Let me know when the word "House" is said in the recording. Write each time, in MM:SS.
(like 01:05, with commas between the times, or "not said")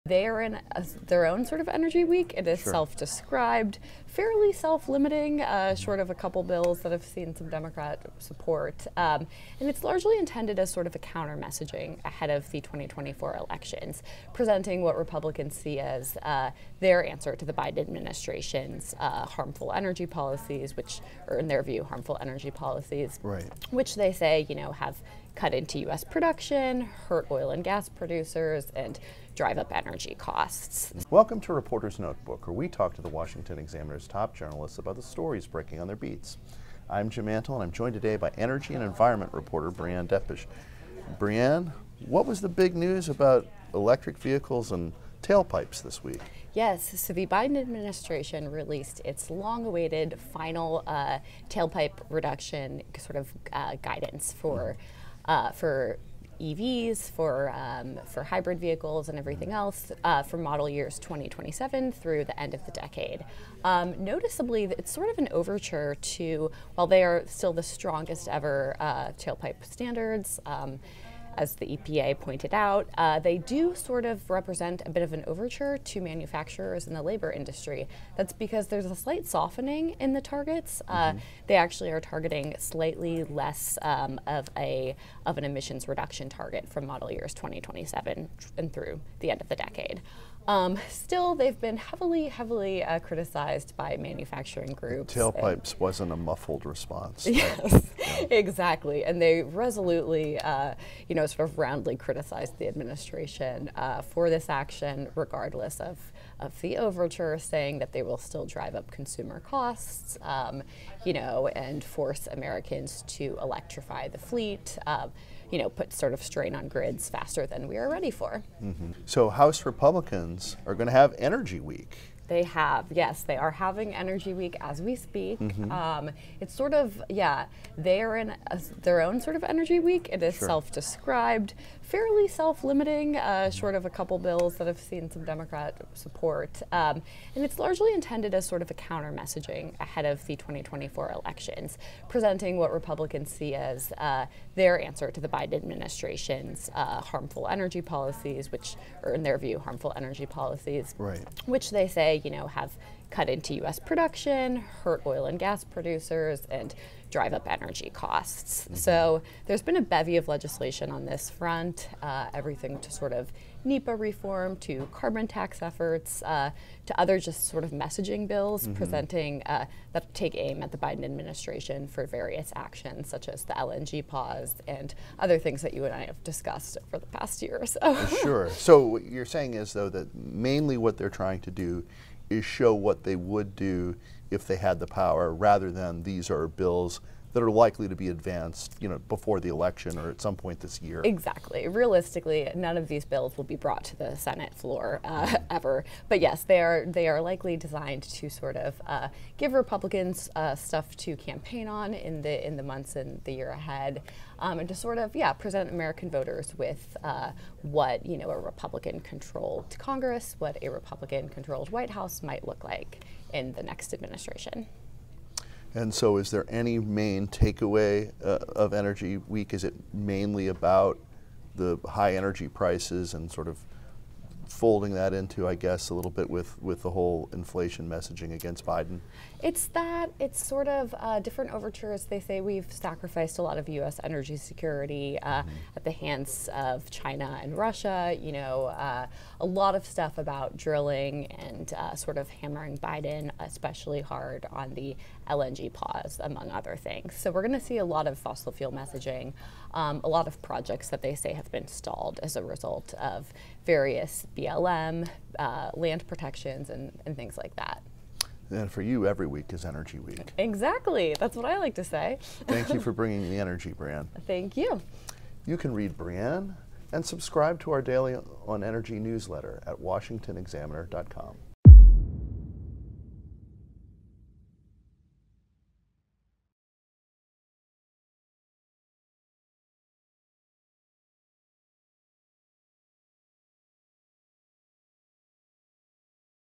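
01:59, 03:31.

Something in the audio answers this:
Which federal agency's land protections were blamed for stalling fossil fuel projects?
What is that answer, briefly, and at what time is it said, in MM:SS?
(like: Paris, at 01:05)
BLM, at 04:14.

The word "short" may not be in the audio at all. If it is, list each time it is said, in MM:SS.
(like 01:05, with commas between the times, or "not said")
00:05, 02:13.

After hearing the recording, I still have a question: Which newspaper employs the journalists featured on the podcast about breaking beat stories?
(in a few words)
Washington Examiner.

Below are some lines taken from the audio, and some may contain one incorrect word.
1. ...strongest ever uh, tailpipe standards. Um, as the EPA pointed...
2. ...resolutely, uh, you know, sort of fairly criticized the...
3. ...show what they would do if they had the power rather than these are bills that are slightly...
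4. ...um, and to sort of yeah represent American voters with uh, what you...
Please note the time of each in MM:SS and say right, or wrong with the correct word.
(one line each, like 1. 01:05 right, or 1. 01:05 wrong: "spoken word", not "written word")
1. 01:07 right
2. 01:39 wrong: "roundly", not "fairly"
3. 03:02 wrong: "likely", not "slightly"
4. 03:24 wrong: "present", not "represent".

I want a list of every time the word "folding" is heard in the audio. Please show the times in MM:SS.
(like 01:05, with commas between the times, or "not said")
03:44.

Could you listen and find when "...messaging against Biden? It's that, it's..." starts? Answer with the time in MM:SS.
03:47.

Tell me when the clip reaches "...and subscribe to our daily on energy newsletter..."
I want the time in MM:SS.
04:26.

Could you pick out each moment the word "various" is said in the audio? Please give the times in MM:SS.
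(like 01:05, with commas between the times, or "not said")
02:52, 04:13.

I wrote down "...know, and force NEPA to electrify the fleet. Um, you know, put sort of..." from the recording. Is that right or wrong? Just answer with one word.
wrong.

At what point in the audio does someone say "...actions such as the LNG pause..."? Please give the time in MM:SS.
02:52.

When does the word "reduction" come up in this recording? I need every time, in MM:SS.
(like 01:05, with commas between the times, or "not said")
00:52, 01:25.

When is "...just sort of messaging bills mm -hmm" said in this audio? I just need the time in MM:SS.
02:47.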